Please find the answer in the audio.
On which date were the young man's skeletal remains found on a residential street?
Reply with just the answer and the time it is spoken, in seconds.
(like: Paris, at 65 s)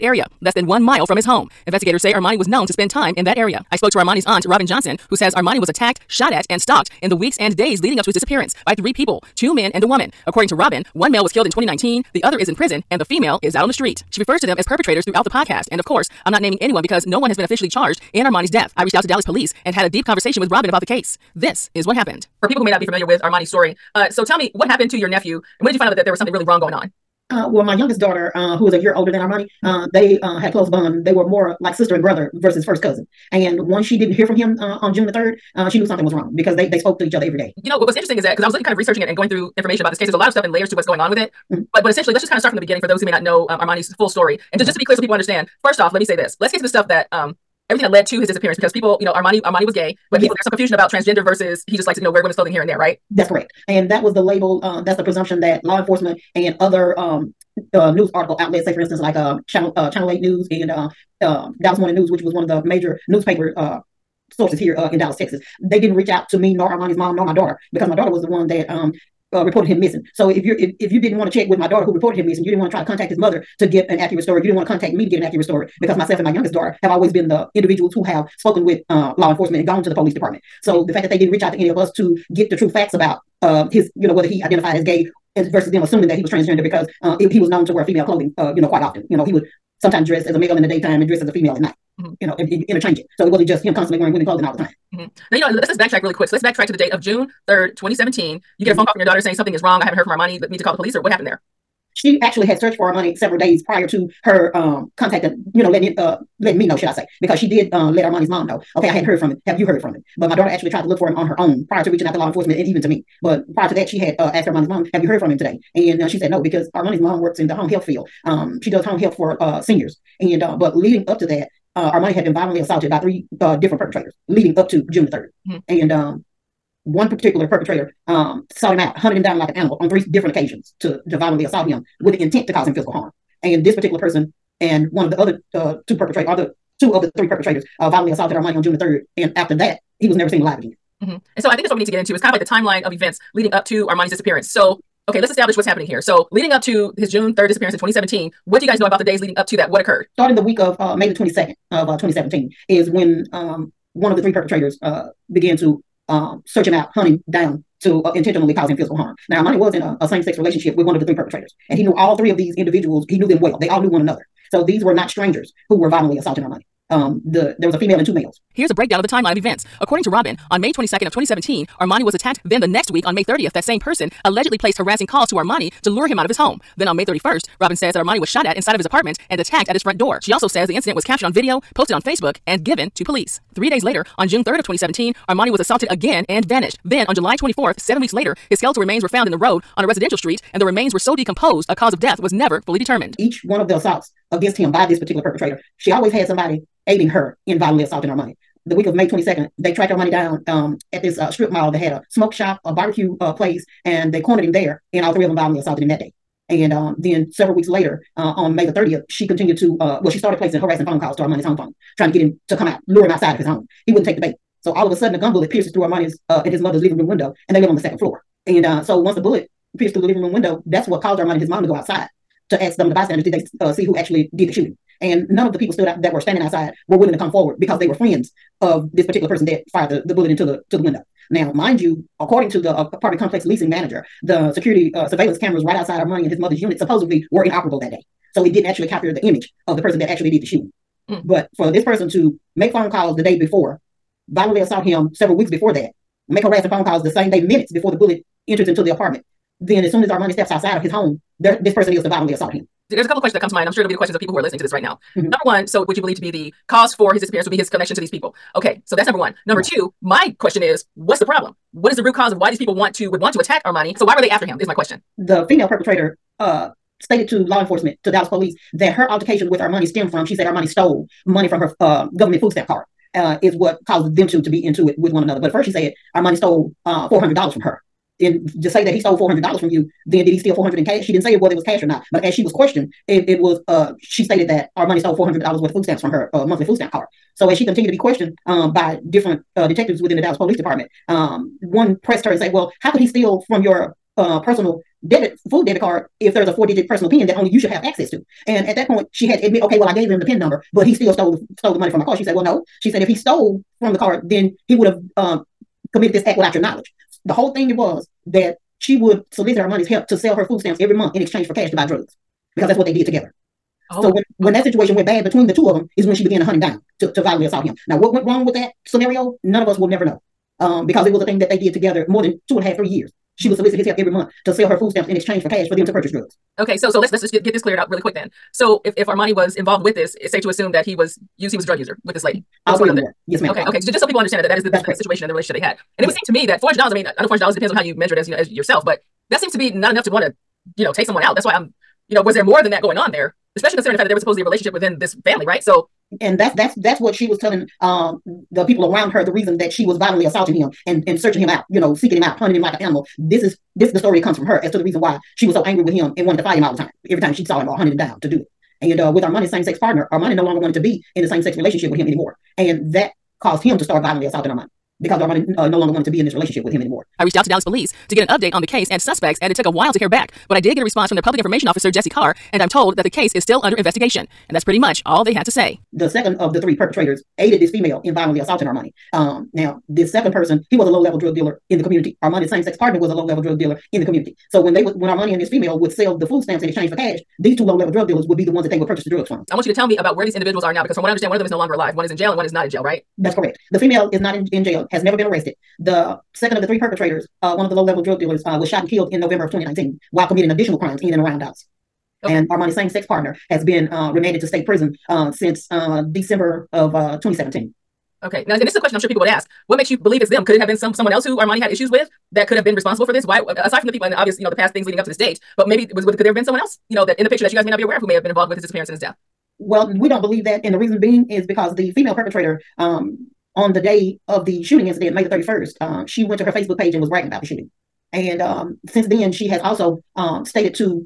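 July 24, at 187 s.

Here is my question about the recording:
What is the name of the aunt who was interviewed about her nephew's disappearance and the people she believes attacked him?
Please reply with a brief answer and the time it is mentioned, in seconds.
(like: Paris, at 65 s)
Robin Johnson, at 4 s.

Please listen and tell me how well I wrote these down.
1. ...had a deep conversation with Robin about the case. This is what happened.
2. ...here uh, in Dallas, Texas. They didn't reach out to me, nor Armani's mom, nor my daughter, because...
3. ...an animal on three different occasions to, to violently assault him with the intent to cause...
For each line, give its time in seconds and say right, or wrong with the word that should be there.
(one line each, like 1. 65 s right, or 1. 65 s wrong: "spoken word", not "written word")
1. 19 s right
2. 64 s right
3. 129 s right.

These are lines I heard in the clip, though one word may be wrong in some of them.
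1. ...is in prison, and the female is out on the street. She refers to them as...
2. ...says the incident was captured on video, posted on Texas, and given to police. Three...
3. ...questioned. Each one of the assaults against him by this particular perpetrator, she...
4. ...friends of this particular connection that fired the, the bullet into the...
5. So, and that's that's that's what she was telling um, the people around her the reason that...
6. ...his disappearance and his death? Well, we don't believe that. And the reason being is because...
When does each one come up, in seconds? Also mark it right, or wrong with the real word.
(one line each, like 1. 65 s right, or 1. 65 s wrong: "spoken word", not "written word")
1. 12 s right
2. 180 s wrong: "Facebook", not "Texas"
3. 192 s wrong: "determined", not "questioned"
4. 227 s wrong: "person", not "connection"
5. 345 s right
6. 418 s right.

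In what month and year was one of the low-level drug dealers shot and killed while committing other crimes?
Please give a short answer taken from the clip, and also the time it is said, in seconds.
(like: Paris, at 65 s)
November 2019, at 399 s.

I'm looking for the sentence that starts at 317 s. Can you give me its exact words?
Now what went wrong with that scenario?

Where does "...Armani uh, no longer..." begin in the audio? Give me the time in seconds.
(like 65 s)
365 s.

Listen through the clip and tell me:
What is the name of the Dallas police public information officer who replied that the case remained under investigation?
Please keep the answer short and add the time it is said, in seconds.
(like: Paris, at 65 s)
Jesse Carr, at 371 s.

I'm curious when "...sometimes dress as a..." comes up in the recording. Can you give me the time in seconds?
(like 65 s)
89 s.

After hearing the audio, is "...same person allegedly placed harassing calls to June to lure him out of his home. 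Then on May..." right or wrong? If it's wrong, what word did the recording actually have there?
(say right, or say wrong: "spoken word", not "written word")
wrong: "Armani", not "June".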